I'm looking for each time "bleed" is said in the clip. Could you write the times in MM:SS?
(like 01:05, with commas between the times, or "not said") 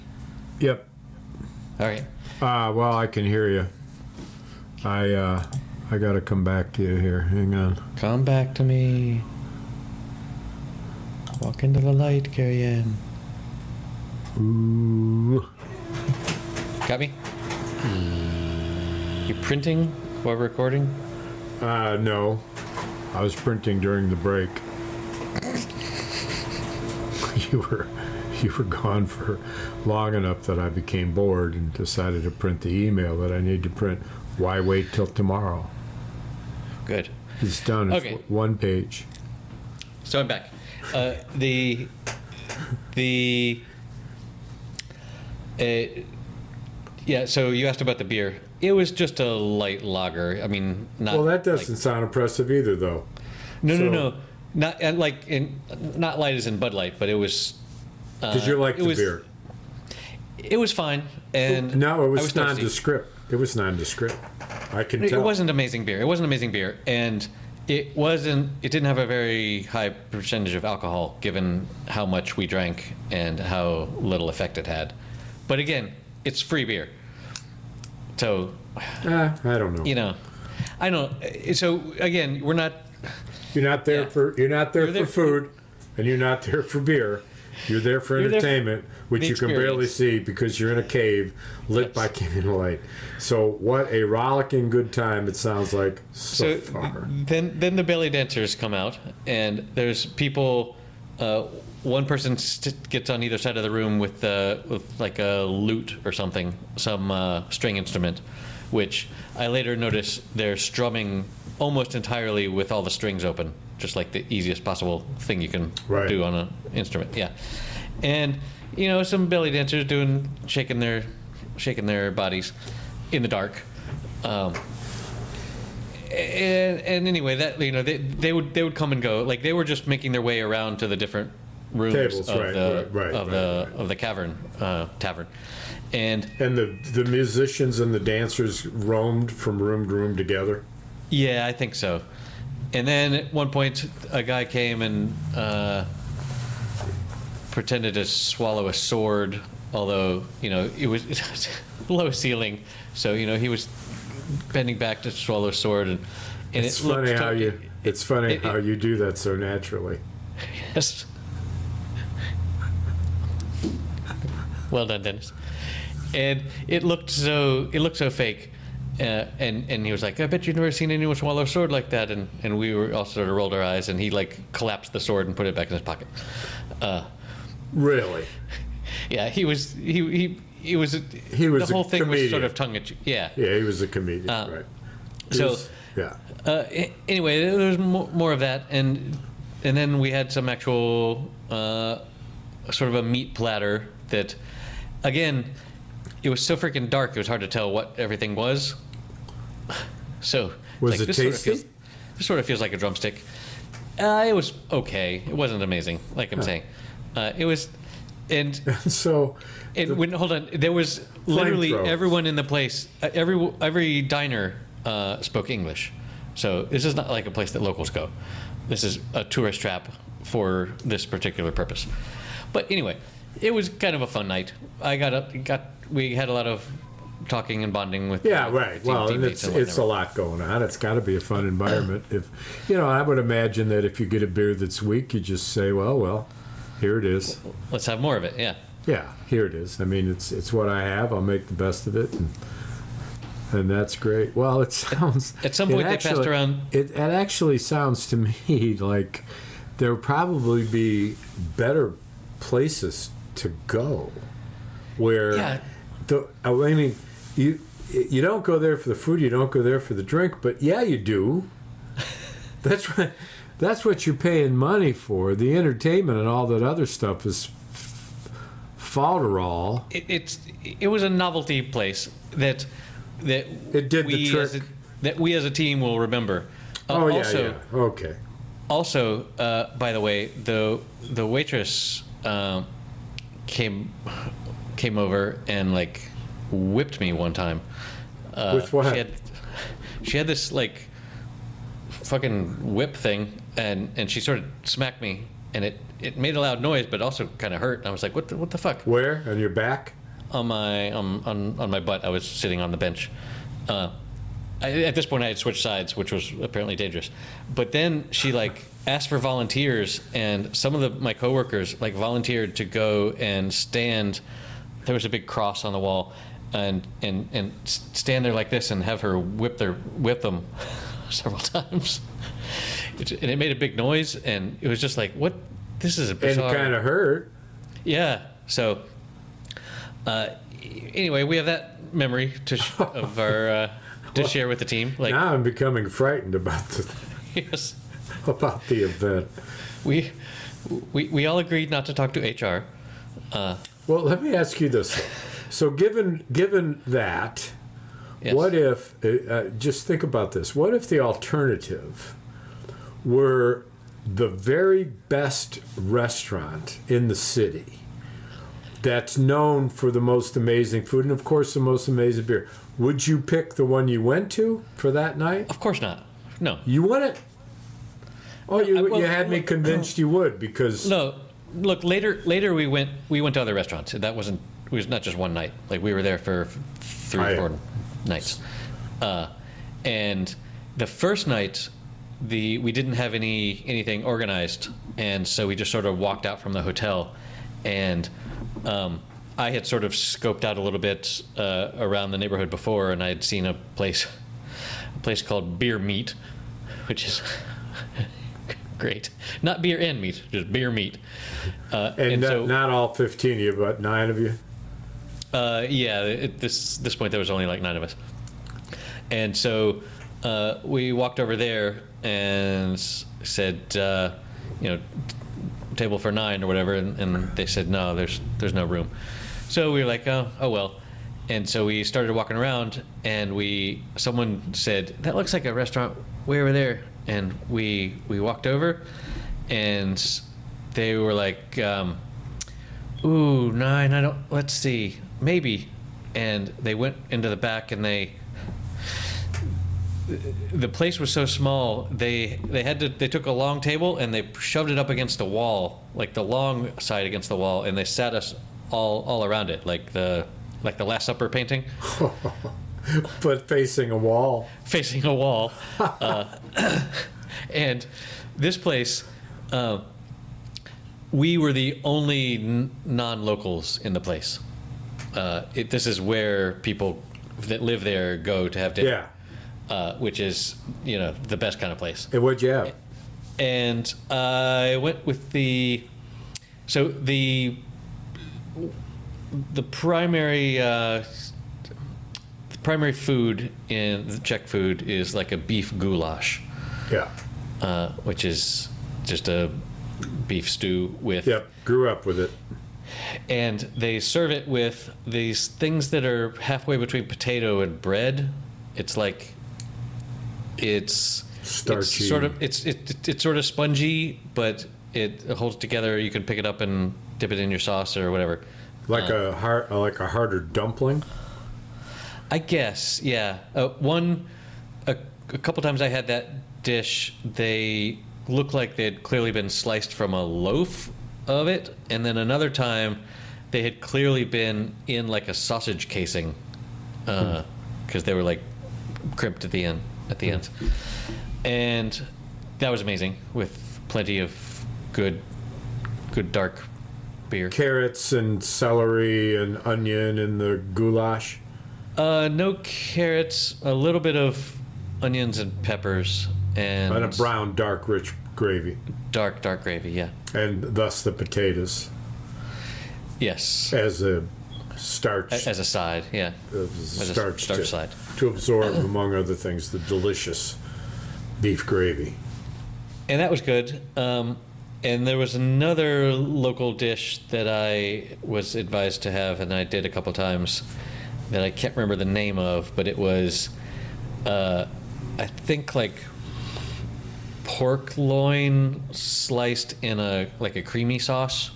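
not said.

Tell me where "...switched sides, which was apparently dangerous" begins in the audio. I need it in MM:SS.
05:05.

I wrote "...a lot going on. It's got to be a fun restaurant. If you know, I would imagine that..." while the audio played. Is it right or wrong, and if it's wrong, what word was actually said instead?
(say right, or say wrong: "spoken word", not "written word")
wrong: "environment", not "restaurant".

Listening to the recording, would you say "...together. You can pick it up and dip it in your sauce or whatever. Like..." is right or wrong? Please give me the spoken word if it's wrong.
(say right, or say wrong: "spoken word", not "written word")
right.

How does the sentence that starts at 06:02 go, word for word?
Would you pick the one you went to for that night?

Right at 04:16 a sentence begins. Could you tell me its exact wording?
the I mean you you don't go there for the food, you don't go there for the drink, but yeah, you do.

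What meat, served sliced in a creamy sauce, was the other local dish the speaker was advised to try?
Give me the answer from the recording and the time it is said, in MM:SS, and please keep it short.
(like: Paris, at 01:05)
Pork loin, at 09:37.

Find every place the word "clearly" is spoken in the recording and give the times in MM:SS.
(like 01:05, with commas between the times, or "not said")
08:39, 08:43.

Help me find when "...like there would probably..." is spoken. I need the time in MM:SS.
04:08.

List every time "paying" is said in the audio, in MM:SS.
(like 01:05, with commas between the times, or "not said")
04:24.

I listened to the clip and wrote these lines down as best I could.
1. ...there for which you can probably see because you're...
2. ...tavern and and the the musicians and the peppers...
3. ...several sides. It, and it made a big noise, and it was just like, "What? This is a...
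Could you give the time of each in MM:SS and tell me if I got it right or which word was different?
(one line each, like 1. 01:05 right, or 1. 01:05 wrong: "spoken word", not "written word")
1. 01:28 wrong: "barely", not "probably"
2. 02:14 wrong: "dancers", not "peppers"
3. 05:21 wrong: "times", not "sides".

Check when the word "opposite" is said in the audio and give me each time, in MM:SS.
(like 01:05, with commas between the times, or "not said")
not said.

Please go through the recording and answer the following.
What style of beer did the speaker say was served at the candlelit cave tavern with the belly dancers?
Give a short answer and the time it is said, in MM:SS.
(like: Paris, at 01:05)
Light lager, at 00:49.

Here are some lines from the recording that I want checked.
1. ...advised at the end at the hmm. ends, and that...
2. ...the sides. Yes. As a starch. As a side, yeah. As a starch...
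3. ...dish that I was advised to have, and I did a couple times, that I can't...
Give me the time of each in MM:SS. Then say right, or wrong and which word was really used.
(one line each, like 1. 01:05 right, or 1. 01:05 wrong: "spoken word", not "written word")
1. 08:49 wrong: "crimped", not "advised"
2. 09:11 wrong: "potatoes", not "sides"
3. 09:26 right.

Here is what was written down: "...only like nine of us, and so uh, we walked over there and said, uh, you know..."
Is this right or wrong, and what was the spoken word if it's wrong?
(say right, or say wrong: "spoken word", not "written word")
right.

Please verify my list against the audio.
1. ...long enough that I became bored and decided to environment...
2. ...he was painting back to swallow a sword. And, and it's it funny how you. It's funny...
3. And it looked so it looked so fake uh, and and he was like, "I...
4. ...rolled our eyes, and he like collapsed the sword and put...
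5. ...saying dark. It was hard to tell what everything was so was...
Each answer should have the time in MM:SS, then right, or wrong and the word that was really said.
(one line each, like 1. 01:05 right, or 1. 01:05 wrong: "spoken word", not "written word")
1. 00:29 wrong: "print", not "environment"
2. 02:33 wrong: "bending", not "painting"
3. 02:46 right
4. 02:53 right
5. 03:16 wrong: "freaking", not "saying".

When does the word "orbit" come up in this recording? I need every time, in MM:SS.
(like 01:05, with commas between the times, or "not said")
not said.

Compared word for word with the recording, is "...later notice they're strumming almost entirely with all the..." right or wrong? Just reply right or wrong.
right.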